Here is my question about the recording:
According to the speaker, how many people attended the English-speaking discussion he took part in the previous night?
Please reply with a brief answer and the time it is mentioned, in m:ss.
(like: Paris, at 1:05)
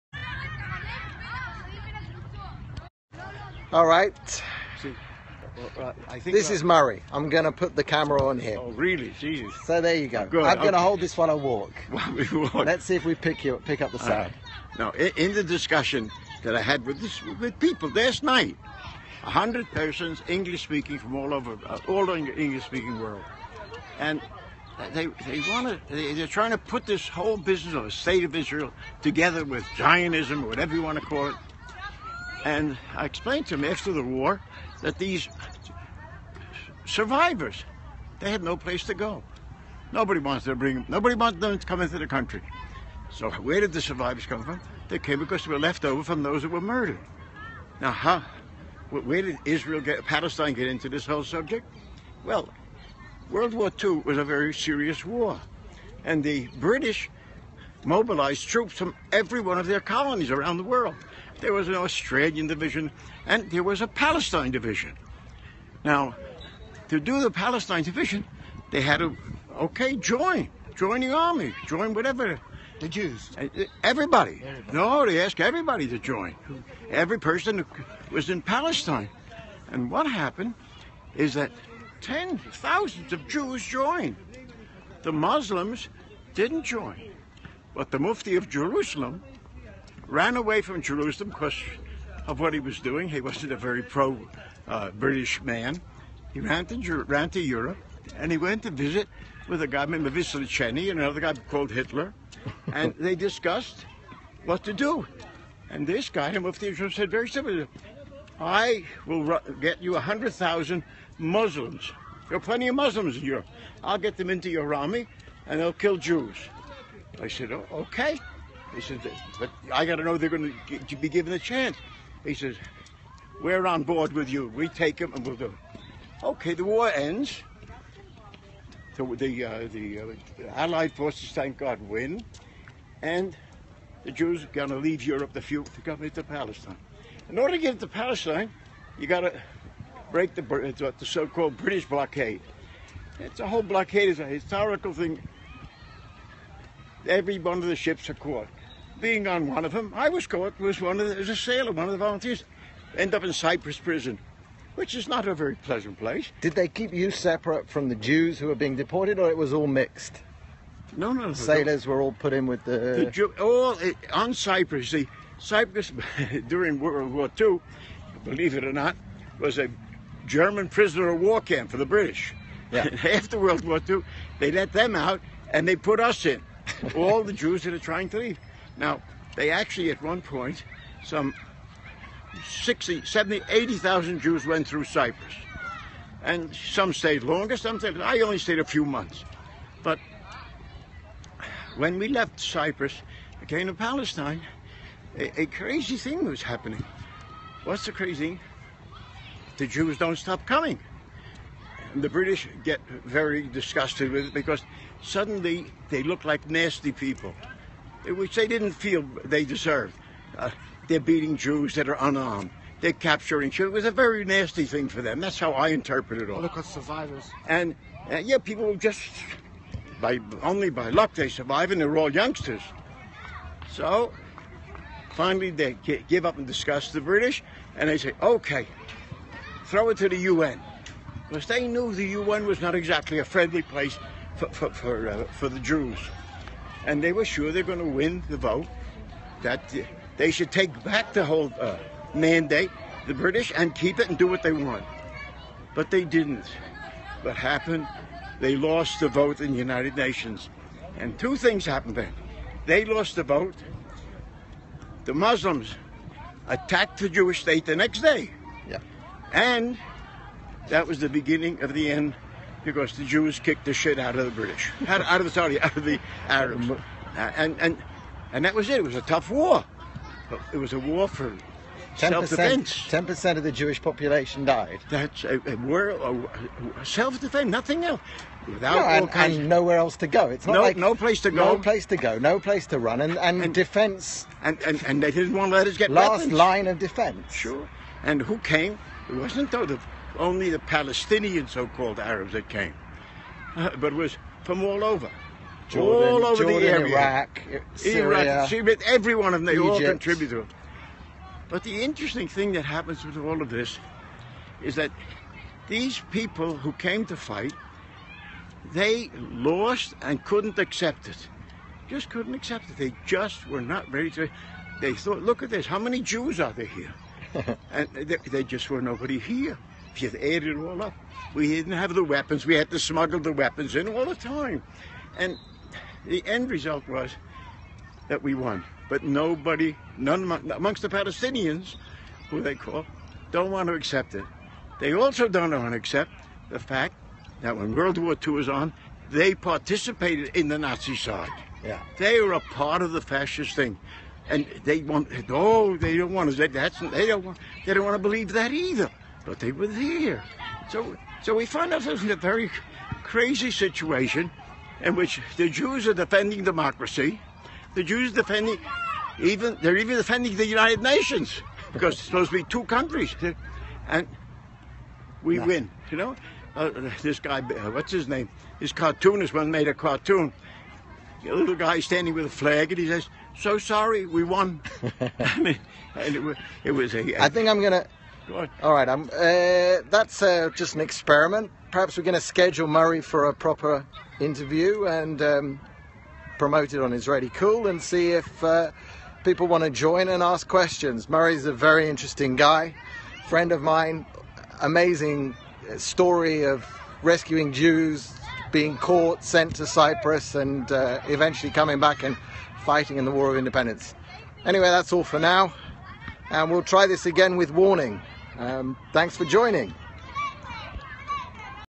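100, at 0:19.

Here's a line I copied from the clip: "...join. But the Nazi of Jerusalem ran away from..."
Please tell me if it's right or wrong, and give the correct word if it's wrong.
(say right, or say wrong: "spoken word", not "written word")
wrong: "Mufti", not "Nazi".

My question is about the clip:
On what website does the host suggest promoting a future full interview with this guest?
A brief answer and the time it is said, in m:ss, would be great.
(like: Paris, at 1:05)
Israellycool, at 6:26.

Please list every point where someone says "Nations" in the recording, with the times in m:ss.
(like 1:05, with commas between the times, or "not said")
4:09, 6:00.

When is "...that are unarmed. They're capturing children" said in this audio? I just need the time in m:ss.
3:31.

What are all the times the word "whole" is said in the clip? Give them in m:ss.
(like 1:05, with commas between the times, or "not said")
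0:27, 0:51, 2:23, 4:01.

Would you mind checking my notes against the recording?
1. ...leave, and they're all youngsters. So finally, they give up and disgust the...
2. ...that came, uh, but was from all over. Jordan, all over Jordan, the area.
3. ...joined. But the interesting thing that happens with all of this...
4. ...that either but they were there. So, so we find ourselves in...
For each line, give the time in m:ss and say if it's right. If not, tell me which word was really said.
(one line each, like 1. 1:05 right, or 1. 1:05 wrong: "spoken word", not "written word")
1. 3:41 wrong: "survive", not "leave"
2. 4:52 right
3. 4:59 wrong: "contributed", not "joined"
4. 5:48 right.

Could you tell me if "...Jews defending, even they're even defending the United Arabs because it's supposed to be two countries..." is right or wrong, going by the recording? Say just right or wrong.
wrong.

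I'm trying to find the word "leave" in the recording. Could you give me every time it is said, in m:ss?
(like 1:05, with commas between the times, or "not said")
2:14, 2:58.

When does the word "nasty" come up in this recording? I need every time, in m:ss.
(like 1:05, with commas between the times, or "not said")
3:26, 3:34.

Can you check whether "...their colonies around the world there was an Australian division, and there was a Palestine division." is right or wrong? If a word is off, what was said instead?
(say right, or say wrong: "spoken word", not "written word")
right.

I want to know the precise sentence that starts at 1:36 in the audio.
He ran to, ran to Europe and he went to visit with a guy named Vicentini and another guy called Hitler.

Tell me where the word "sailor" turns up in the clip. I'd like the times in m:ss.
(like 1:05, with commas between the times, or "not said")
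2:31, 2:41.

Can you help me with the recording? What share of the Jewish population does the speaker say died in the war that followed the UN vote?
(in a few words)
10%.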